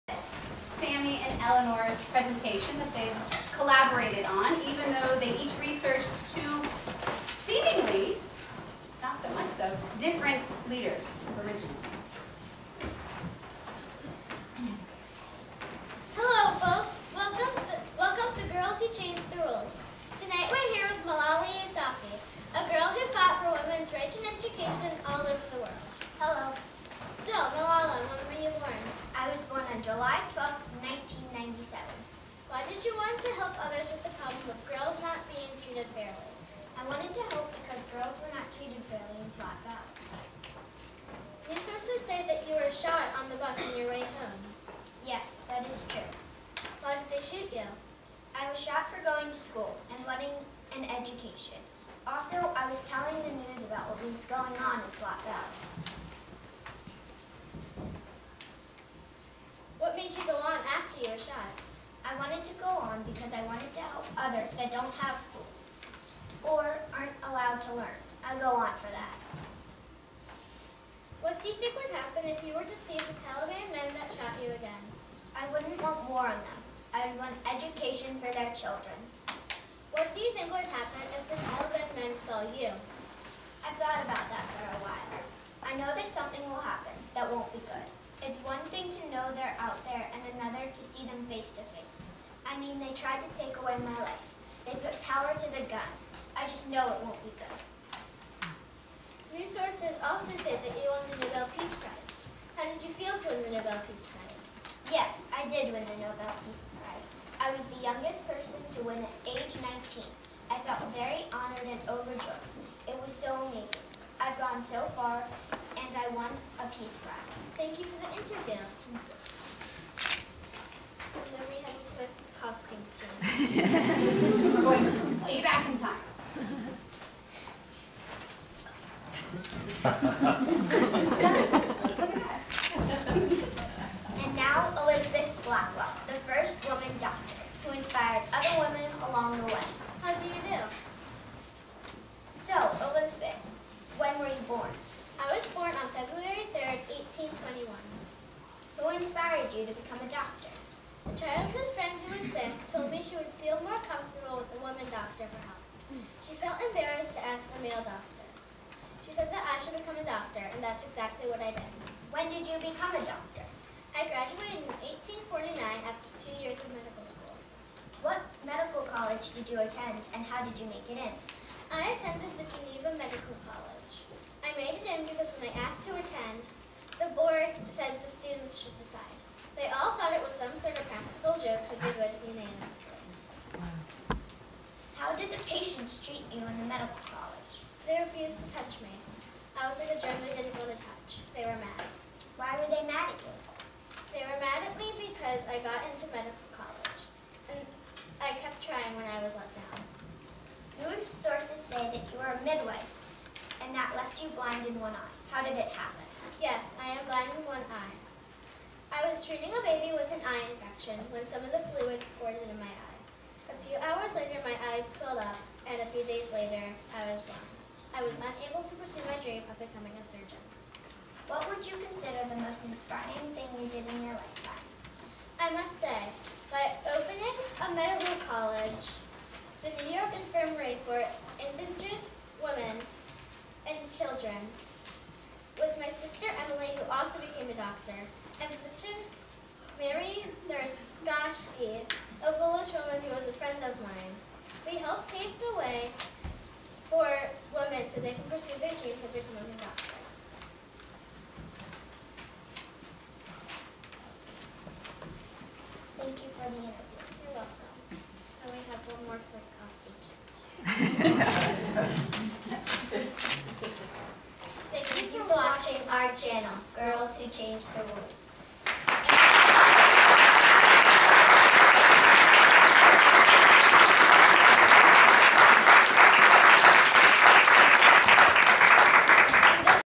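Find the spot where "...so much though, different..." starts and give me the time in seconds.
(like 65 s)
9 s.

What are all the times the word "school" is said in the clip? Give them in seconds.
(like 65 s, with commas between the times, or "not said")
49 s, 65 s, 167 s.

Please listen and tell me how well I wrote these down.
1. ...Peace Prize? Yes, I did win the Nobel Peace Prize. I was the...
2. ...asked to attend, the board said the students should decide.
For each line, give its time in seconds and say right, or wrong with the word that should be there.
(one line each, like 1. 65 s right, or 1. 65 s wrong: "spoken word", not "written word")
1. 103 s right
2. 175 s right.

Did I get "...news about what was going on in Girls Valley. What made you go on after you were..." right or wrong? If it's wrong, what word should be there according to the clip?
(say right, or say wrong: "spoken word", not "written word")
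wrong: "Swat", not "Girls".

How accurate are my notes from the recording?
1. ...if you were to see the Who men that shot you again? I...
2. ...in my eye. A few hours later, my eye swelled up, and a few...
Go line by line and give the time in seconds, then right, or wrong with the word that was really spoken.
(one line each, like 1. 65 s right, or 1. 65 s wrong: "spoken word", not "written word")
1. 72 s wrong: "Taliban", not "Who"
2. 212 s right.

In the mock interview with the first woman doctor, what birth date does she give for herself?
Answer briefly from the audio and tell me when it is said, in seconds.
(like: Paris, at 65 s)
February 3rd, 1821, at 145 s.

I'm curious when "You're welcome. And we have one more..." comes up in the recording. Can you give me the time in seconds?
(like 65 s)
257 s.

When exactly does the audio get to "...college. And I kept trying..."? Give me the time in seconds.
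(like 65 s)
196 s.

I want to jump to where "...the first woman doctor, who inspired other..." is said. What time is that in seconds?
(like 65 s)
136 s.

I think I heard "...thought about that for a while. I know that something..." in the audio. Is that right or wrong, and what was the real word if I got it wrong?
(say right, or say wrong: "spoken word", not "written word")
right.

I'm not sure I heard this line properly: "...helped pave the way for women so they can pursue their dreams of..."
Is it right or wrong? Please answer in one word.
right.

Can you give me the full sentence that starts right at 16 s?
Hello folks, welcome to, welcome to Girls Who Change the Rules.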